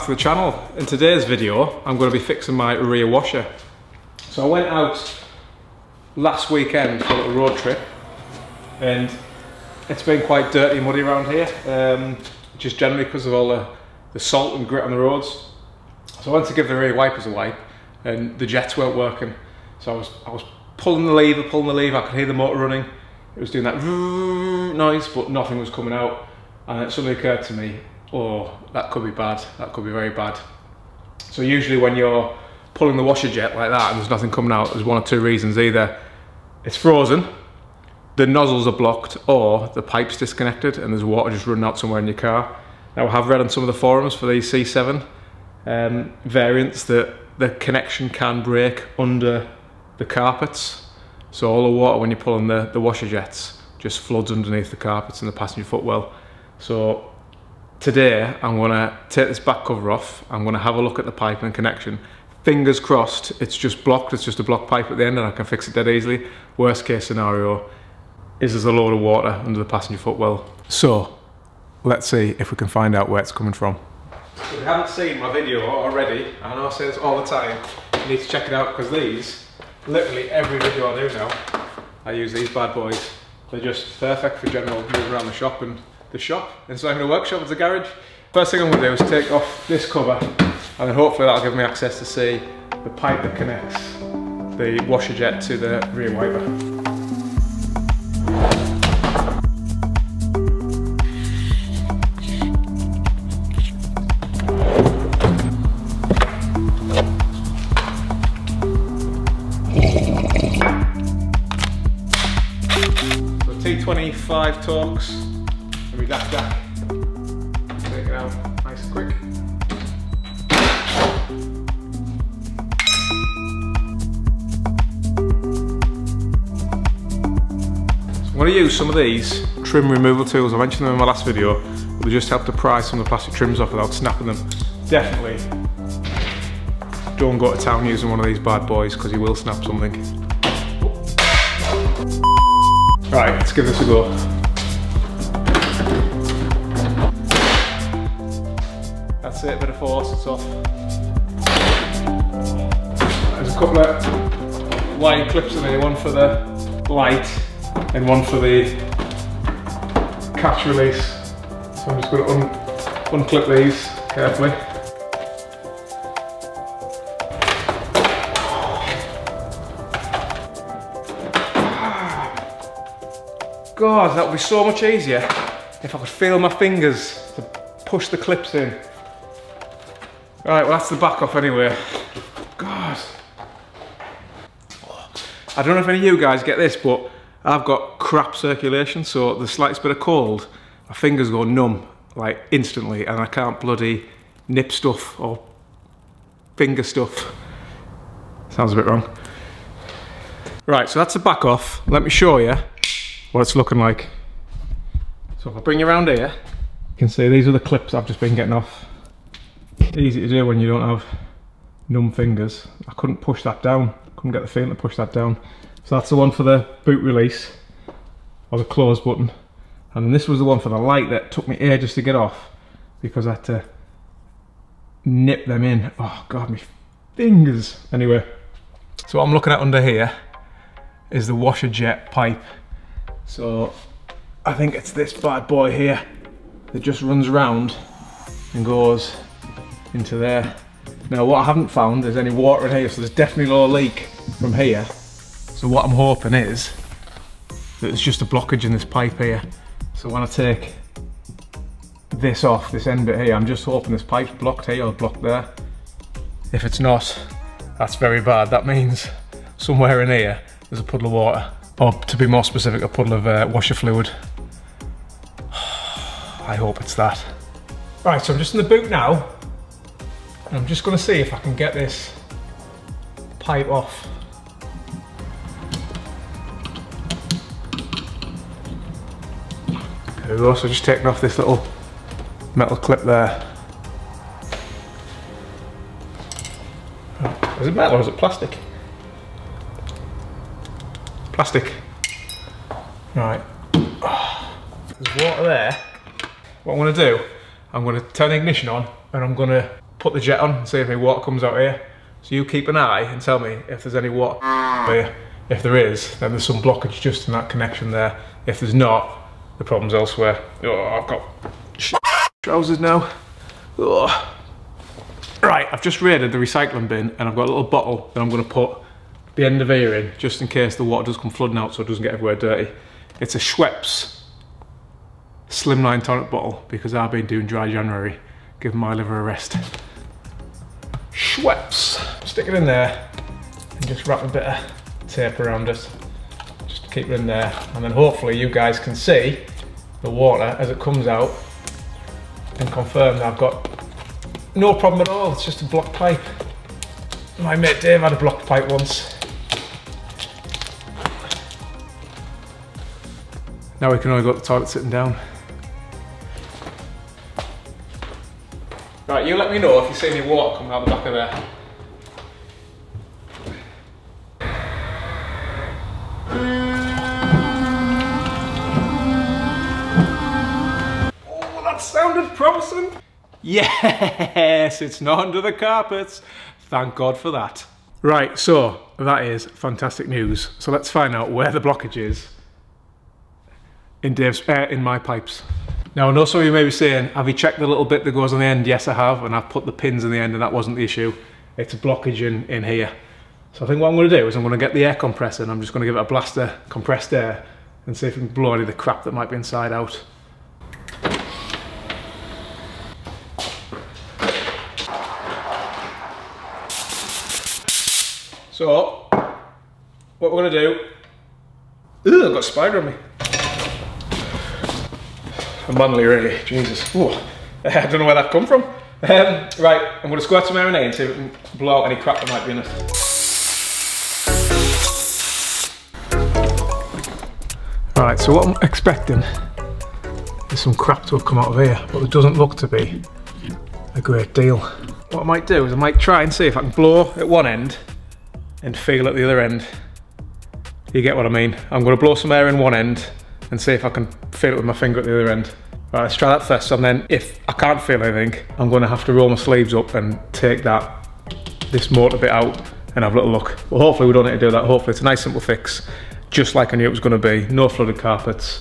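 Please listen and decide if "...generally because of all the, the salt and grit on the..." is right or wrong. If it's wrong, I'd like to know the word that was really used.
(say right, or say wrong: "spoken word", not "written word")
right.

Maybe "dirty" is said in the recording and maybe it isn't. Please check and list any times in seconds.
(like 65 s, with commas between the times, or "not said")
10 s, 322 s.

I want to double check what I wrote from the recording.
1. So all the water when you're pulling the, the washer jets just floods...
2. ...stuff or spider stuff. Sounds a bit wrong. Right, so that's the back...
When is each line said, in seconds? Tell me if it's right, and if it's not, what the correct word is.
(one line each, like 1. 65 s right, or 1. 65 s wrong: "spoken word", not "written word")
1. 51 s right
2. 194 s wrong: "finger", not "spider".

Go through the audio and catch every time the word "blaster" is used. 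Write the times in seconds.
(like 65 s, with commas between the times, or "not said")
396 s.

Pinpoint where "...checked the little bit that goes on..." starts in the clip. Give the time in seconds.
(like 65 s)
387 s.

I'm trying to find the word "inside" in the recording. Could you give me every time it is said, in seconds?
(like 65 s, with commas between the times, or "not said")
399 s.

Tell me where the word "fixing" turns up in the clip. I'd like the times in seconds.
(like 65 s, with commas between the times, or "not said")
2 s.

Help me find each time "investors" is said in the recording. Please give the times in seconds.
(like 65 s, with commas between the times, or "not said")
not said.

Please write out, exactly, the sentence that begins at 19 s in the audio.
So I was, I was pulling the lever, pulling the lever, I could hear the motor running.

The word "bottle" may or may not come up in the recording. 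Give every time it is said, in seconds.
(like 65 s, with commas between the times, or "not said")
317 s, 326 s.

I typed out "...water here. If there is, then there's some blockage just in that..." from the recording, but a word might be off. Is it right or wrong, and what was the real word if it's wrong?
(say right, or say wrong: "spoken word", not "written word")
right.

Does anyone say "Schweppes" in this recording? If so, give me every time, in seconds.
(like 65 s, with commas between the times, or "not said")
323 s, 331 s.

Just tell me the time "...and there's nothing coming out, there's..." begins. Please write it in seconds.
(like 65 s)
33 s.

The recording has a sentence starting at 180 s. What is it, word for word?
Right, well that's the back off anyway.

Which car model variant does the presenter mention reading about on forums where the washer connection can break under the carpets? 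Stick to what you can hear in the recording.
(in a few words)
C7.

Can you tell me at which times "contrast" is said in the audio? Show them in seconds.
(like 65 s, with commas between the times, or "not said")
not said.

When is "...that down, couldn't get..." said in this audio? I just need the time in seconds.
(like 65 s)
213 s.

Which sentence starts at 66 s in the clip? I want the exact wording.
Worst case scenario is there's a load of water under the passenger footwell.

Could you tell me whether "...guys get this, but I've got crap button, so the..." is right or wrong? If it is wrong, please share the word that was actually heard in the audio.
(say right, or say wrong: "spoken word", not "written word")
wrong: "circulation", not "button".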